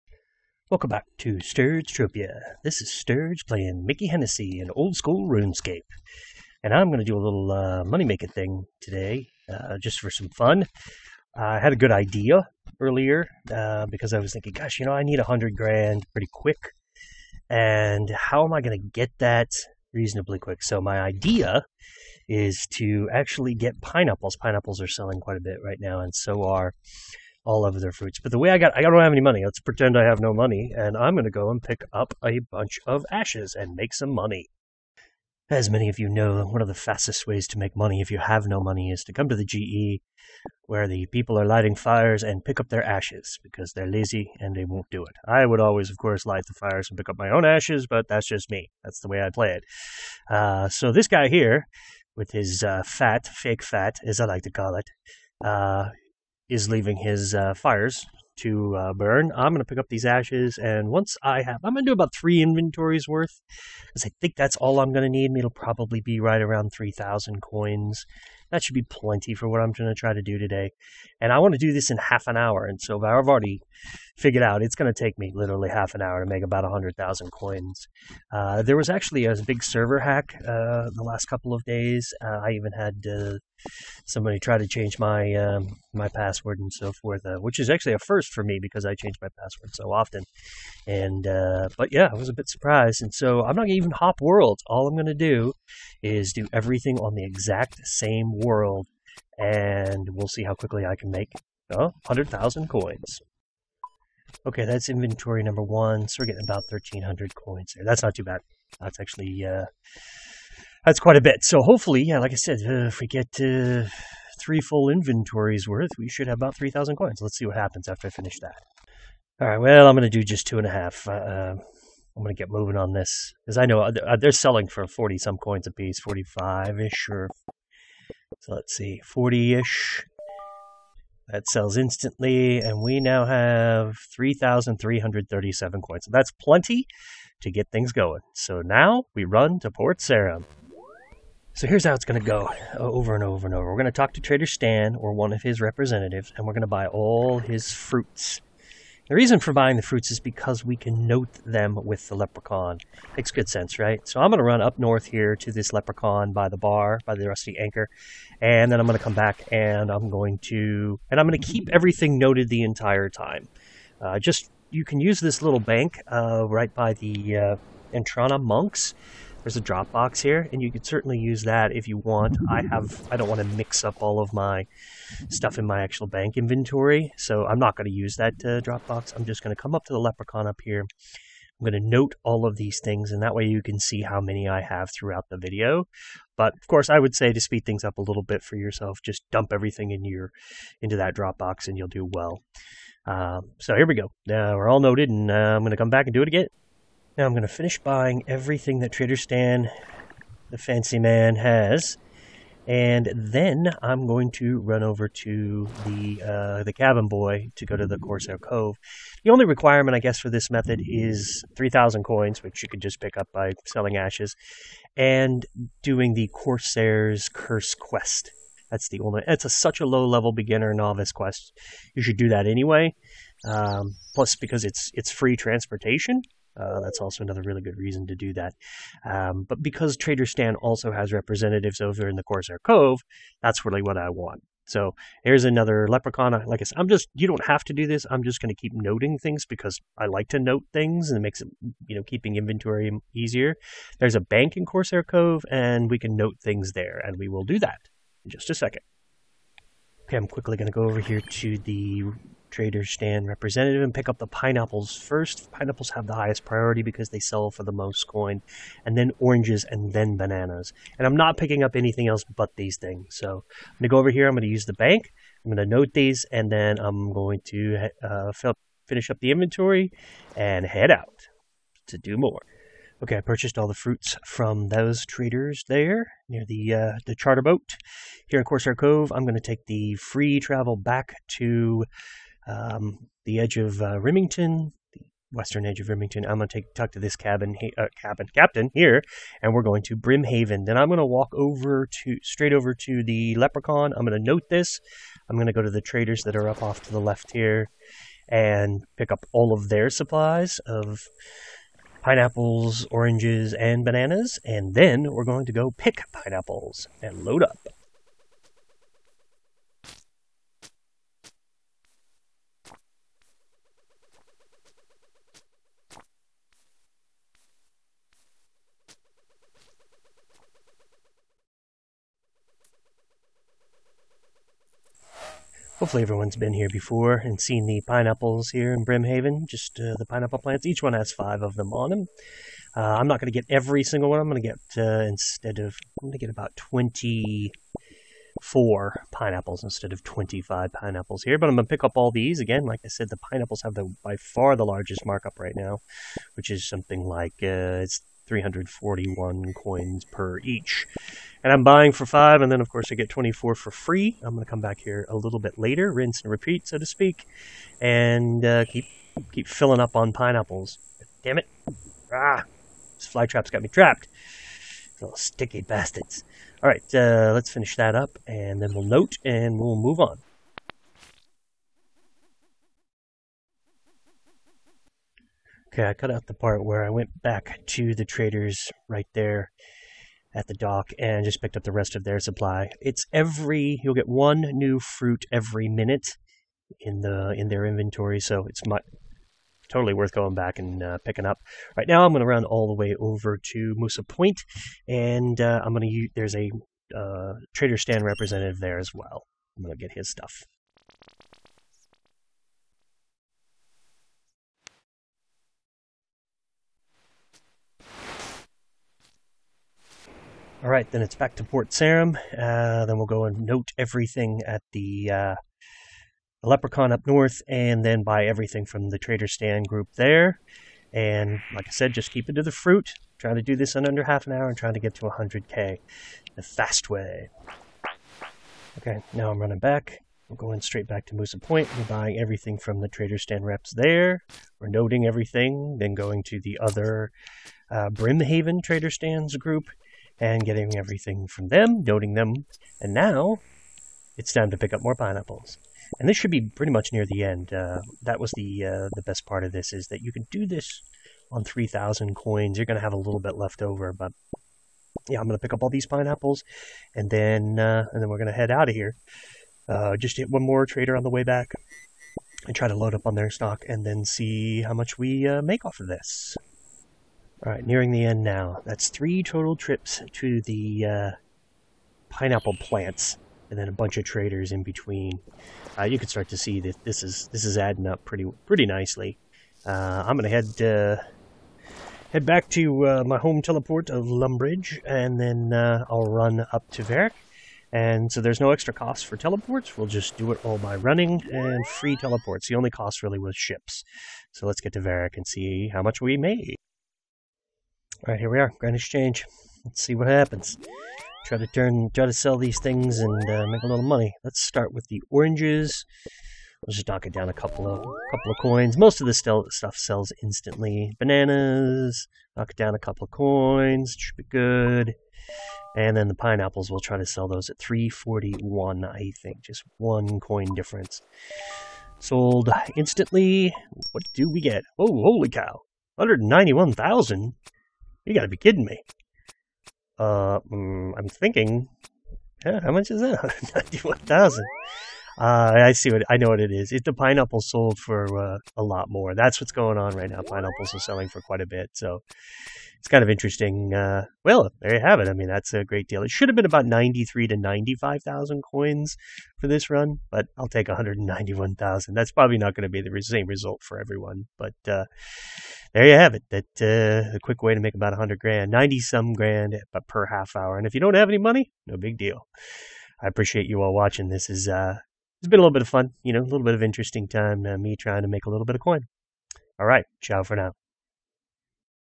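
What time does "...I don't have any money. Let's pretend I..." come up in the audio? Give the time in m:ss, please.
0:28.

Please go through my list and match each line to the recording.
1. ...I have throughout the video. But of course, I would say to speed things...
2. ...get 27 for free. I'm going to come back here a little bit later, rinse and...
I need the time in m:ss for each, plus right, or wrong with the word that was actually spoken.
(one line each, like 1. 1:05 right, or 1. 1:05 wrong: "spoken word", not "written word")
1. 3:04 right
2. 5:52 wrong: "24", not "27".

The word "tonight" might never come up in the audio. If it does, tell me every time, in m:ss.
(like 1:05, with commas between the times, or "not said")
not said.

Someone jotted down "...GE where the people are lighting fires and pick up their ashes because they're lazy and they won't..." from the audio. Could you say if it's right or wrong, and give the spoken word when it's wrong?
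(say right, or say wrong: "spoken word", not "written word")
right.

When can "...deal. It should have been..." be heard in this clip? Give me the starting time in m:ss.
9:05.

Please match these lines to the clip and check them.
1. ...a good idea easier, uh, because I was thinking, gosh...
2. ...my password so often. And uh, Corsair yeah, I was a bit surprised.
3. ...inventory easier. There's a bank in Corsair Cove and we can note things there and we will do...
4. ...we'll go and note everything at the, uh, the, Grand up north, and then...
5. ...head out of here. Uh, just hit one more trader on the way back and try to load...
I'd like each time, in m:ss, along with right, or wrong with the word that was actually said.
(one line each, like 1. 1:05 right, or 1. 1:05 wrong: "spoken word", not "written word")
1. 0:11 wrong: "earlier", not "easier"
2. 1:29 wrong: "But", not "Corsair"
3. 4:02 right
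4. 6:52 wrong: "Leprechaun", not "Grand"
5. 7:38 right.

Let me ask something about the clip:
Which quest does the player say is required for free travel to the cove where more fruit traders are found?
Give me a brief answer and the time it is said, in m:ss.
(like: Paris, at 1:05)
Corsair's Curse, at 3:36.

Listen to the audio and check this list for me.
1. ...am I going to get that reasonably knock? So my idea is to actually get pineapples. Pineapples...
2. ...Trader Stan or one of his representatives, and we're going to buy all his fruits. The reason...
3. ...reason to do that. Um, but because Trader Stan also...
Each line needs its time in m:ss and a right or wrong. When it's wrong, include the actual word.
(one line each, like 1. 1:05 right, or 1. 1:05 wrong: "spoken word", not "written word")
1. 0:18 wrong: "quick", not "knock"
2. 2:24 right
3. 3:47 right.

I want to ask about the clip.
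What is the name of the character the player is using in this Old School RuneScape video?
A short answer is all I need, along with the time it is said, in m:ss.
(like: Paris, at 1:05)
Mickey Hennessy, at 0:03.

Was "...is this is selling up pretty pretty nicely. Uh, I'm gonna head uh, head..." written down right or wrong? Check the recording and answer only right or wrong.
wrong.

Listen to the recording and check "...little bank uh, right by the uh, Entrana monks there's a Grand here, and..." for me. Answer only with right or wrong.
wrong.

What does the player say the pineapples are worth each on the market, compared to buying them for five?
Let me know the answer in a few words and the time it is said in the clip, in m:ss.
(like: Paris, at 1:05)
341 coins, at 5:48.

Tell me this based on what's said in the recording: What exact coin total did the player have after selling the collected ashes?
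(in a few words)
3,337.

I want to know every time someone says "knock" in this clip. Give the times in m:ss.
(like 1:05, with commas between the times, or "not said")
8:26, 8:32.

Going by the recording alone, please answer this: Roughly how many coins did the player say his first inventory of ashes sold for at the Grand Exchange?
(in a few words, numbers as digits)
1,300.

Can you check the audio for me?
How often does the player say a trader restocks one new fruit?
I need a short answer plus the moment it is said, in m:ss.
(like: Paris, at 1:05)
every minute, at 6:25.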